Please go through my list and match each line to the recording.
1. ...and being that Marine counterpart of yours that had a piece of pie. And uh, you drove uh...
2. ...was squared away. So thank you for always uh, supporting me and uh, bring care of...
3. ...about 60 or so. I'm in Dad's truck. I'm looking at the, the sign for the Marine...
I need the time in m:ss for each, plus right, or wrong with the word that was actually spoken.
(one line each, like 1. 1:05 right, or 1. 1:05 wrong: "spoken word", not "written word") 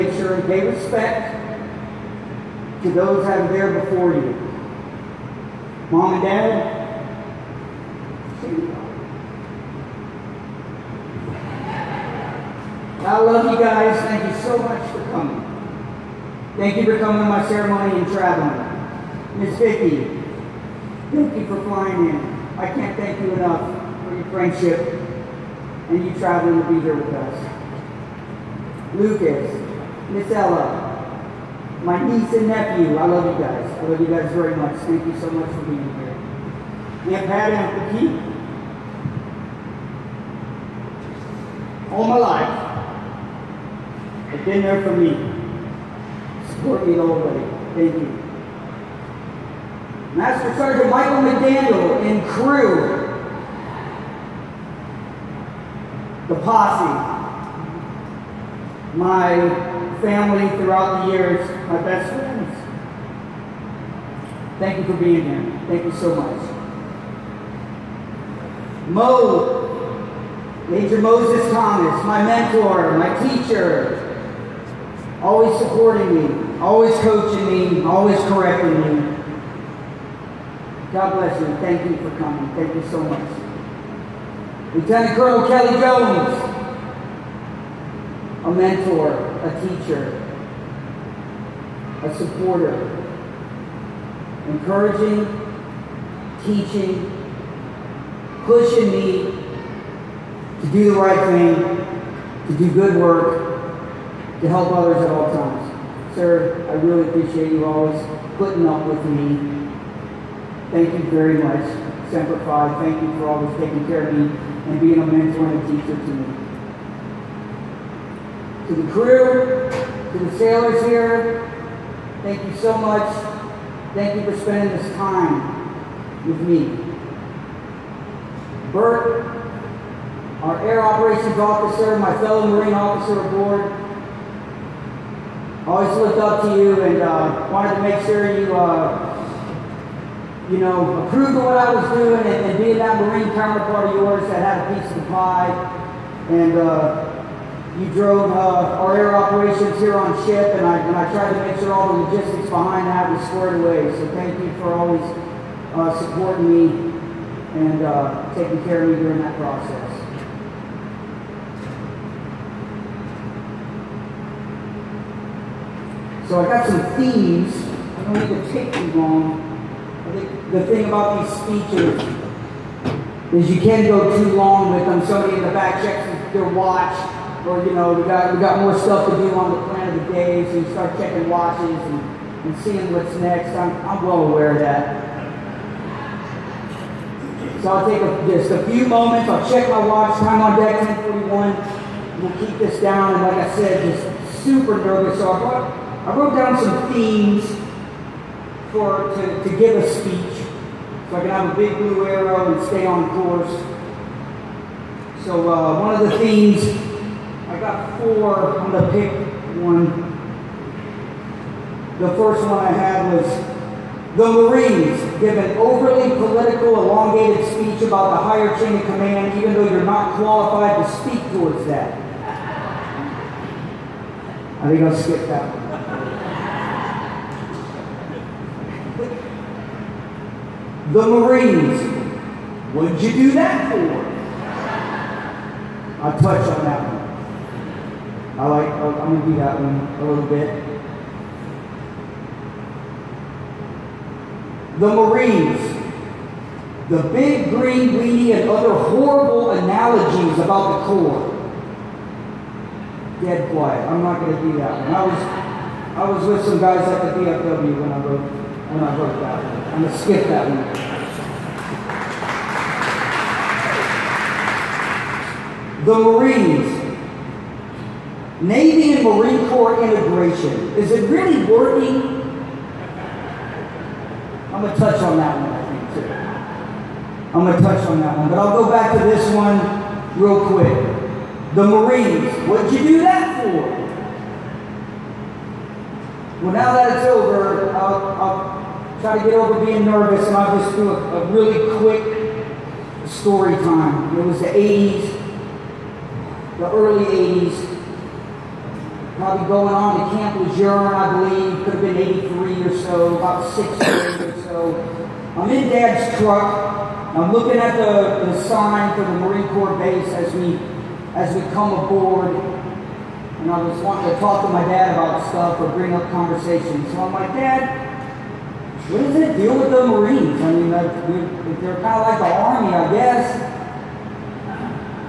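1. 2:22 right
2. 2:33 wrong: "taking", not "bring"
3. 5:03 right.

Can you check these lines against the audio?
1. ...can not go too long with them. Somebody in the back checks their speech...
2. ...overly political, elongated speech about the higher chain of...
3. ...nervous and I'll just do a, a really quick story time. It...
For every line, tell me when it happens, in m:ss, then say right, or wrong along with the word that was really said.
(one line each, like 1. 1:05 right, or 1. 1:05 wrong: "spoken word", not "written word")
1. 2:53 wrong: "watch", not "speech"
2. 3:35 right
3. 4:49 right.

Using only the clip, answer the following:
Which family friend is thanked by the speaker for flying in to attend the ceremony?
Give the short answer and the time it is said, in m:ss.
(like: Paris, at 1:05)
Miss Vicki, at 0:19.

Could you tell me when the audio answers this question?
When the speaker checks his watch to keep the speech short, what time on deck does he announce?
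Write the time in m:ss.
3:10.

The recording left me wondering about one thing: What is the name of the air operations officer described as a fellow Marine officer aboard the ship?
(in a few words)
Bert.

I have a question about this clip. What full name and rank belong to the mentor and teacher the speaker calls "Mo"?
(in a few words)
Major Moses Thomas.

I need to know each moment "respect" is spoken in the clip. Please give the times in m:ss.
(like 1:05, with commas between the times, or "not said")
0:00.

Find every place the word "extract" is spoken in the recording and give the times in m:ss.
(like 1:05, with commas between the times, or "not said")
not said.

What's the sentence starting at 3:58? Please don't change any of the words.
I like, I'm going to do that one a little bit.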